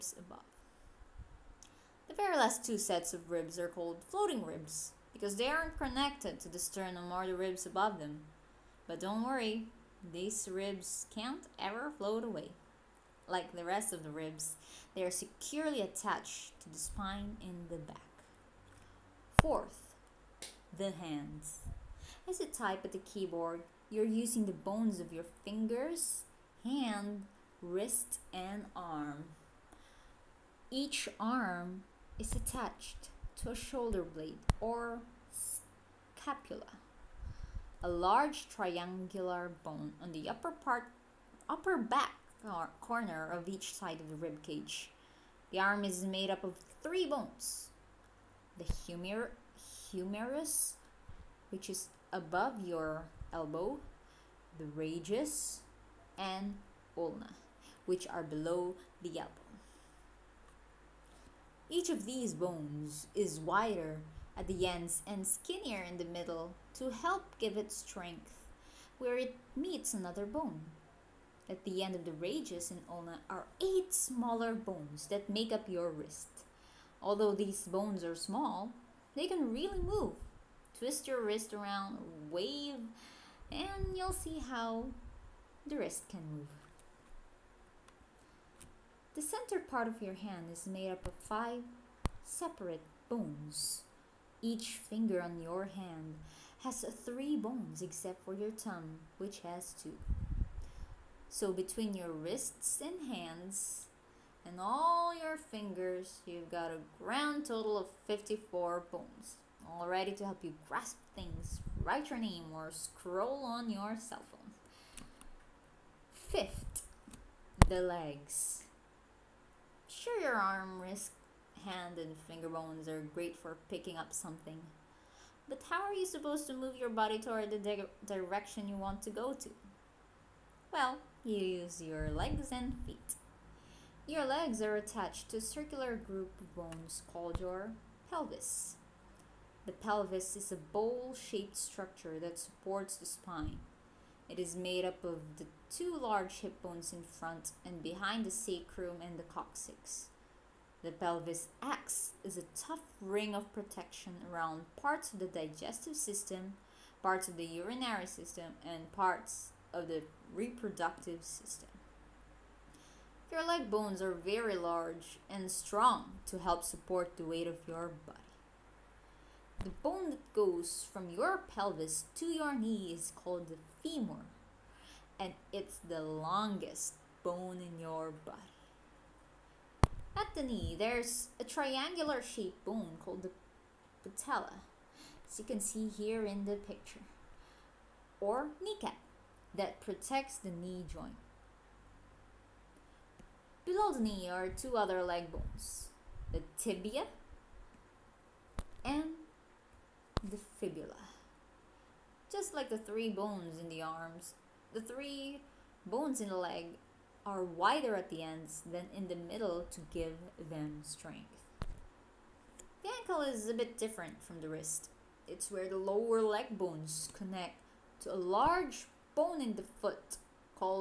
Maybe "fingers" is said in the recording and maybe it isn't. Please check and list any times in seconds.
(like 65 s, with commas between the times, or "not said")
25 s, 94 s, 105 s, 122 s.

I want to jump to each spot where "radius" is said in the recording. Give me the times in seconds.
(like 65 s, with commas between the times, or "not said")
54 s, 72 s.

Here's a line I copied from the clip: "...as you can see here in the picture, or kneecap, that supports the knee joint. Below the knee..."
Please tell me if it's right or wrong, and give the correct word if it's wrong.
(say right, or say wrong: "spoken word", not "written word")
wrong: "protects", not "supports".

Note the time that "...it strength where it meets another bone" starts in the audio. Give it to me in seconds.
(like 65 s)
67 s.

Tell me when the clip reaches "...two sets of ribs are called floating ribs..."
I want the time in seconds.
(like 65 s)
2 s.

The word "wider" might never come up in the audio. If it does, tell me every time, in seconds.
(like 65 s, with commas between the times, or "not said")
63 s, 207 s.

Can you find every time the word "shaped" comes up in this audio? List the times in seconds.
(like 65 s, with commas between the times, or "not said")
141 s, 182 s.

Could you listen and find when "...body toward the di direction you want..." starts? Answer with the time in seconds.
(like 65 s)
126 s.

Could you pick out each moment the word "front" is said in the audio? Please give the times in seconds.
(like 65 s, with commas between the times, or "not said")
147 s.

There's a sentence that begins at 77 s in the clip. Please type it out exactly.
Although these bones are small, they can really move.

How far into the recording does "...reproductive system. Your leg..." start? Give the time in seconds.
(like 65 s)
160 s.